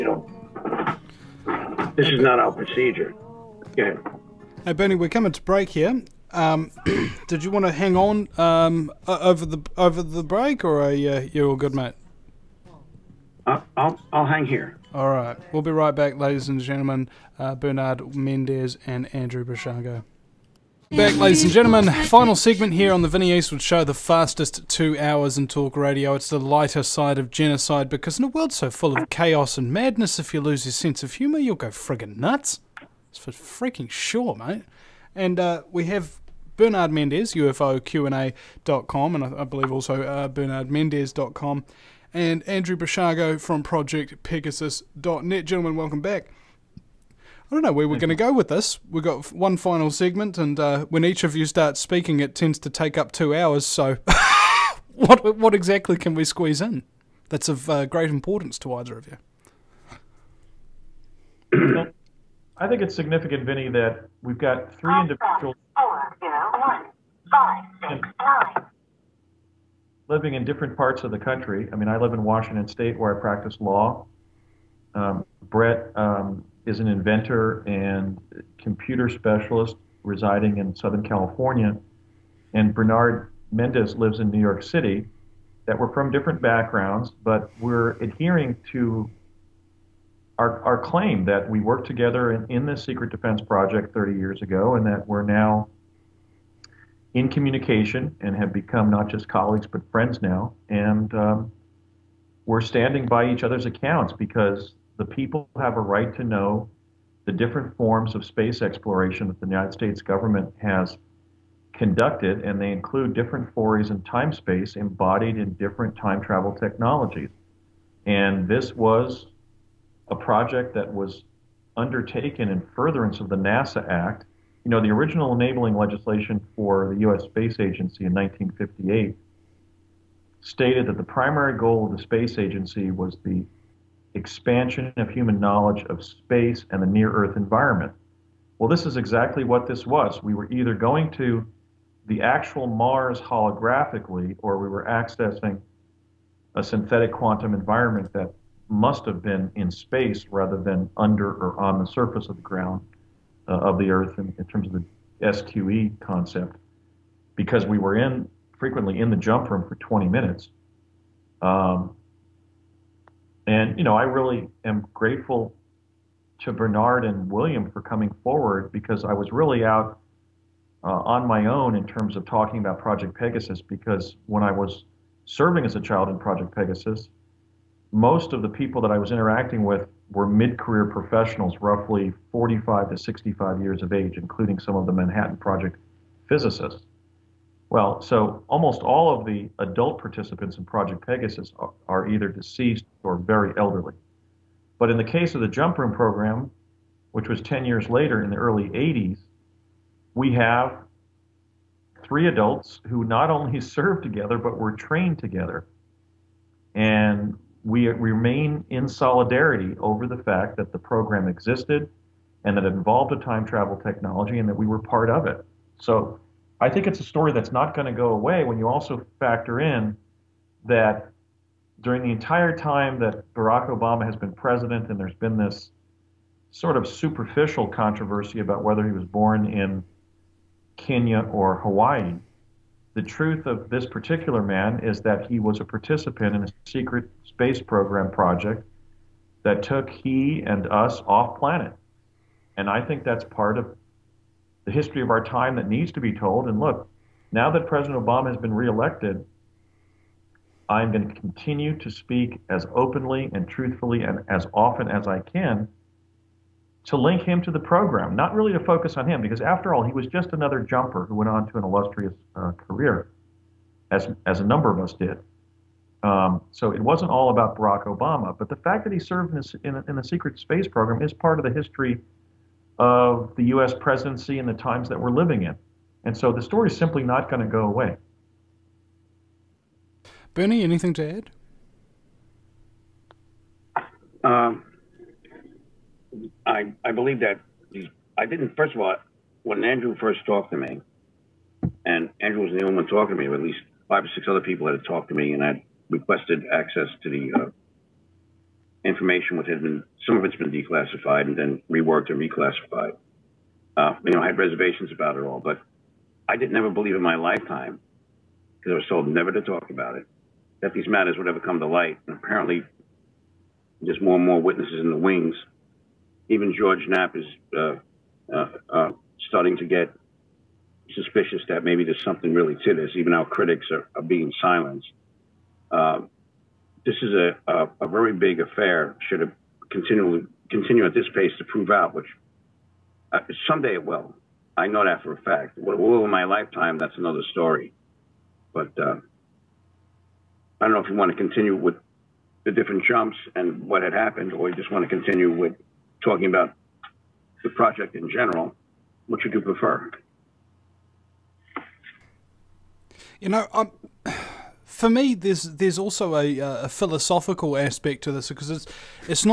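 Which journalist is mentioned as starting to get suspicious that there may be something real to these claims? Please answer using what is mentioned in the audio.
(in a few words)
George Knapp.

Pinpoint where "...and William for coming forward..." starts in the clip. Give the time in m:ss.
2:47.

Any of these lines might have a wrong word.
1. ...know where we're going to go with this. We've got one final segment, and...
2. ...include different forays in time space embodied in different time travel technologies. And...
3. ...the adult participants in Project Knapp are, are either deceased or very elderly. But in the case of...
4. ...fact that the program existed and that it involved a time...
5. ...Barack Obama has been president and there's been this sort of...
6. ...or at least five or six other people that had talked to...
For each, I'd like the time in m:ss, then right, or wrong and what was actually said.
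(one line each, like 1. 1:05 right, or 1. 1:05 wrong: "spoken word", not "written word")
1. 0:47 right
2. 1:52 right
3. 3:09 wrong: "Pegasus", not "Knapp"
4. 3:30 right
5. 3:43 right
6. 4:53 right.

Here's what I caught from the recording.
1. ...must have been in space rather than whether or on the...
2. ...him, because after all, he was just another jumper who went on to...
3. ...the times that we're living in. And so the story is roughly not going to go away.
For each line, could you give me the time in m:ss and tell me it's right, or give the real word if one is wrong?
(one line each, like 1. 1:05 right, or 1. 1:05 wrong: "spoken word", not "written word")
1. 2:28 wrong: "under", not "whether"
2. 4:19 right
3. 4:34 wrong: "simply", not "roughly".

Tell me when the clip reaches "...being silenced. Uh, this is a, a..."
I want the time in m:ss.
5:24.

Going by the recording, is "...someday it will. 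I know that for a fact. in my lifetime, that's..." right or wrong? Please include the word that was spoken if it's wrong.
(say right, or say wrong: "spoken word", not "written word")
right.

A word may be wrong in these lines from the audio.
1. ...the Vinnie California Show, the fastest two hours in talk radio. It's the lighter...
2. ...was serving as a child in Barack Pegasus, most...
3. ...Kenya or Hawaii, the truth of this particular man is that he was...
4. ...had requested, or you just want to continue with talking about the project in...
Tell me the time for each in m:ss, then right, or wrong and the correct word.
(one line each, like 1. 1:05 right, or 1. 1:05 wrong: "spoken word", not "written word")
1. 0:23 wrong: "Eastwood", not "California"
2. 2:54 wrong: "Project", not "Barack"
3. 3:50 right
4. 5:43 wrong: "happened", not "requested".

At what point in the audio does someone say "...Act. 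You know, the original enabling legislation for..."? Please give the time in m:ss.
2:03.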